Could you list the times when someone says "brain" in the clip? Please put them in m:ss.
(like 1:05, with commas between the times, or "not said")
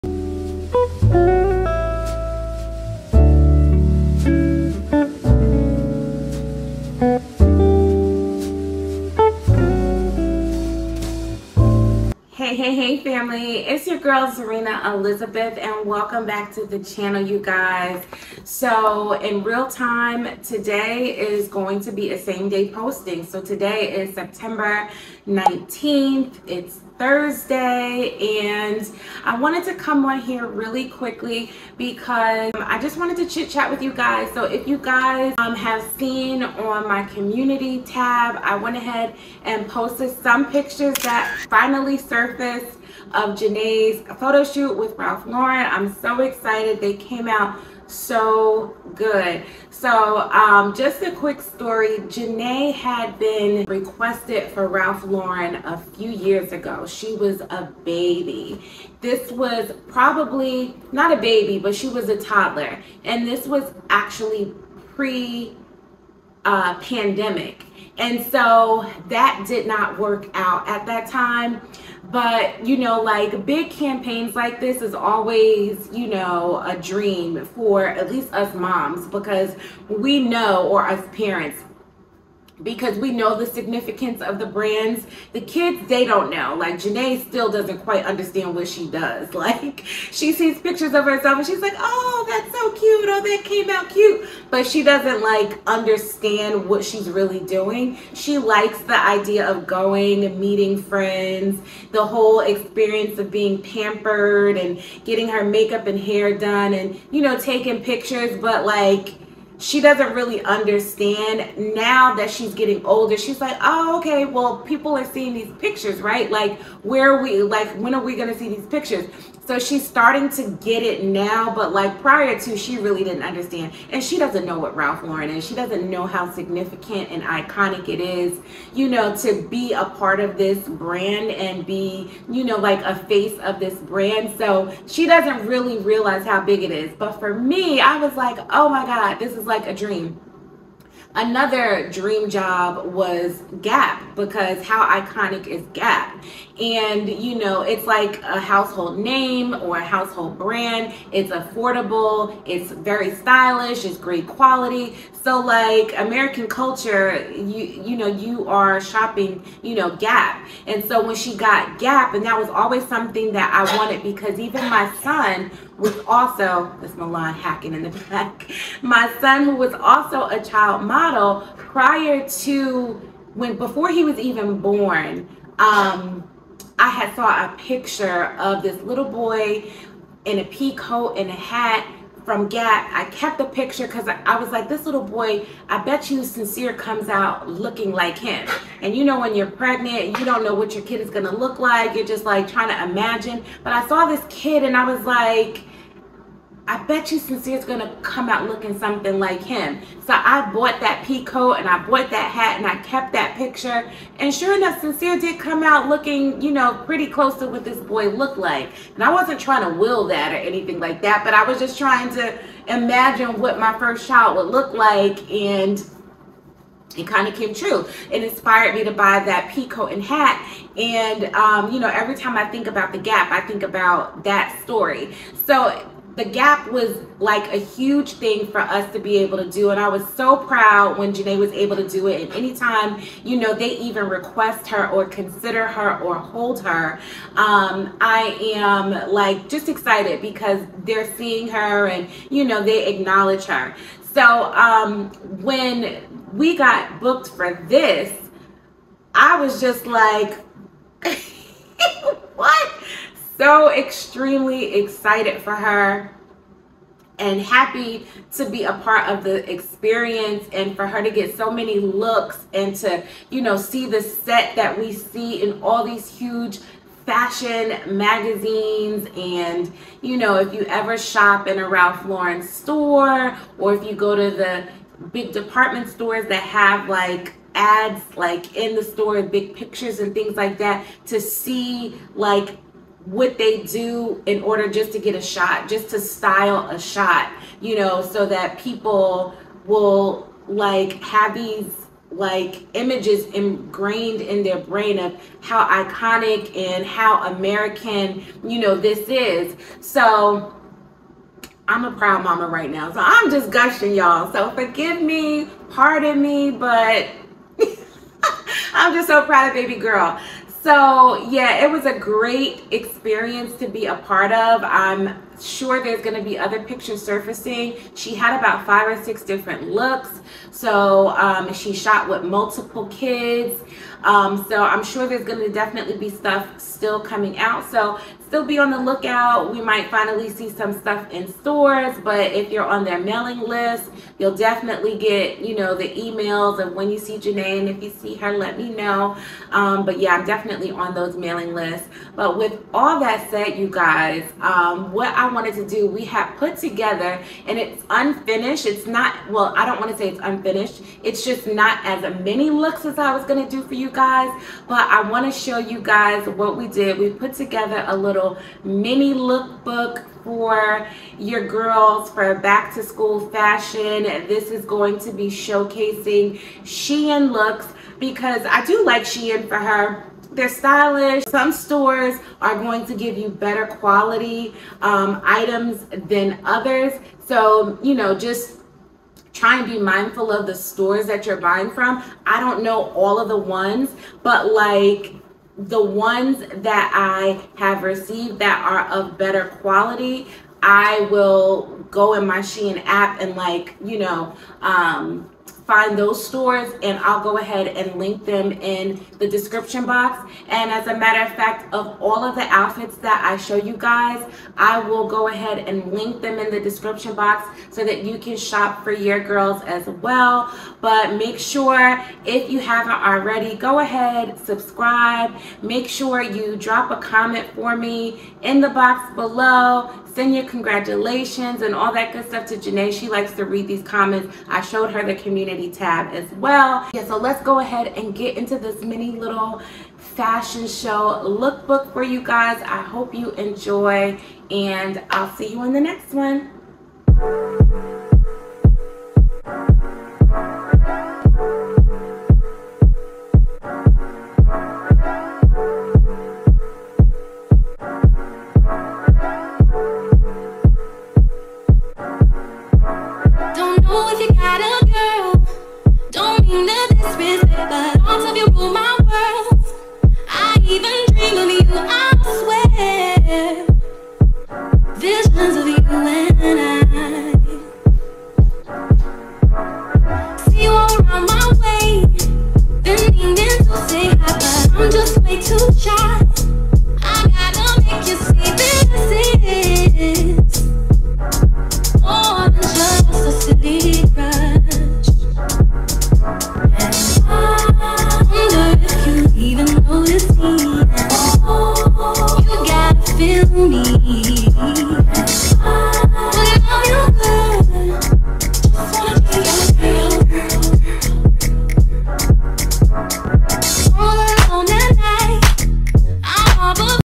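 4:54.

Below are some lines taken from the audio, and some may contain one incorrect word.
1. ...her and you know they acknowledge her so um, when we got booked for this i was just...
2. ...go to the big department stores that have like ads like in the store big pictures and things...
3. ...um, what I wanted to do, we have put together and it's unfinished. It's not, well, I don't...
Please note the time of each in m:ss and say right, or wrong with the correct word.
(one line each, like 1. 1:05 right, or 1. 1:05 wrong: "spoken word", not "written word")
1. 4:01 right
2. 4:33 right
3. 5:44 right.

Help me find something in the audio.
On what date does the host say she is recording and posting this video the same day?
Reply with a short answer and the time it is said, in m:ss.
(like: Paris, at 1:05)
September 19th, at 0:24.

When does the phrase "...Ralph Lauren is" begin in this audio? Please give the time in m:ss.
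2:04.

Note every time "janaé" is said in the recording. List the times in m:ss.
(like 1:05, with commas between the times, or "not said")
0:43, 0:51, 1:26, 3:51, 5:37, 7:02.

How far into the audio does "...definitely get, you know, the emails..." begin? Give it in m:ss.
5:34.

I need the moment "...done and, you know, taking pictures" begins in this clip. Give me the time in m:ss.
1:46.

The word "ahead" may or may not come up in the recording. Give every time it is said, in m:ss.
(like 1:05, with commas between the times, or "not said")
0:38, 6:37, 6:45, 6:53, 7:07.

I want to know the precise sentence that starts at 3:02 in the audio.
I kept the picture because I, I, was like, this little boy, I bet you Sincere comes out looking like him.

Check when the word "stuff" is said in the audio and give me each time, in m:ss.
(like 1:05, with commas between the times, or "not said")
5:26, 5:30, 7:02.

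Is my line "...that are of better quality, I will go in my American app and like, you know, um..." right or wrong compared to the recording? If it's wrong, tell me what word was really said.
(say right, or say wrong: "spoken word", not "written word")
wrong: "Shein", not "American".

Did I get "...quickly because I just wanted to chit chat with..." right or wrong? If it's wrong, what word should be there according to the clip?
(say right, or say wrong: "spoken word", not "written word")
right.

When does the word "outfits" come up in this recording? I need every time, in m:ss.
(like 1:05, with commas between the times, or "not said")
6:42.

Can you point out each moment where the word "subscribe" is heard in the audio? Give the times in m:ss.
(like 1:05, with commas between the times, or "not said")
6:54.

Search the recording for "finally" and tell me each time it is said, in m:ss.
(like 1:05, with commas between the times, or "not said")
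0:41, 5:29.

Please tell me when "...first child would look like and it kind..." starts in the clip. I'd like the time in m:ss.
3:33.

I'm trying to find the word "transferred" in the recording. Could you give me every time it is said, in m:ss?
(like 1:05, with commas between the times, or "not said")
not said.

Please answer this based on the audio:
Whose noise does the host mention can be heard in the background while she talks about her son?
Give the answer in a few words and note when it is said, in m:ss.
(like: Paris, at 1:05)
Milan, at 2:46.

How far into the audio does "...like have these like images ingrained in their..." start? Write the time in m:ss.
4:50.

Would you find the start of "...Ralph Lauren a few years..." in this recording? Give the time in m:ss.
0:54.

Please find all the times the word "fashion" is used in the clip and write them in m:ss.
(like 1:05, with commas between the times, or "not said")
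4:27, 6:03, 7:09.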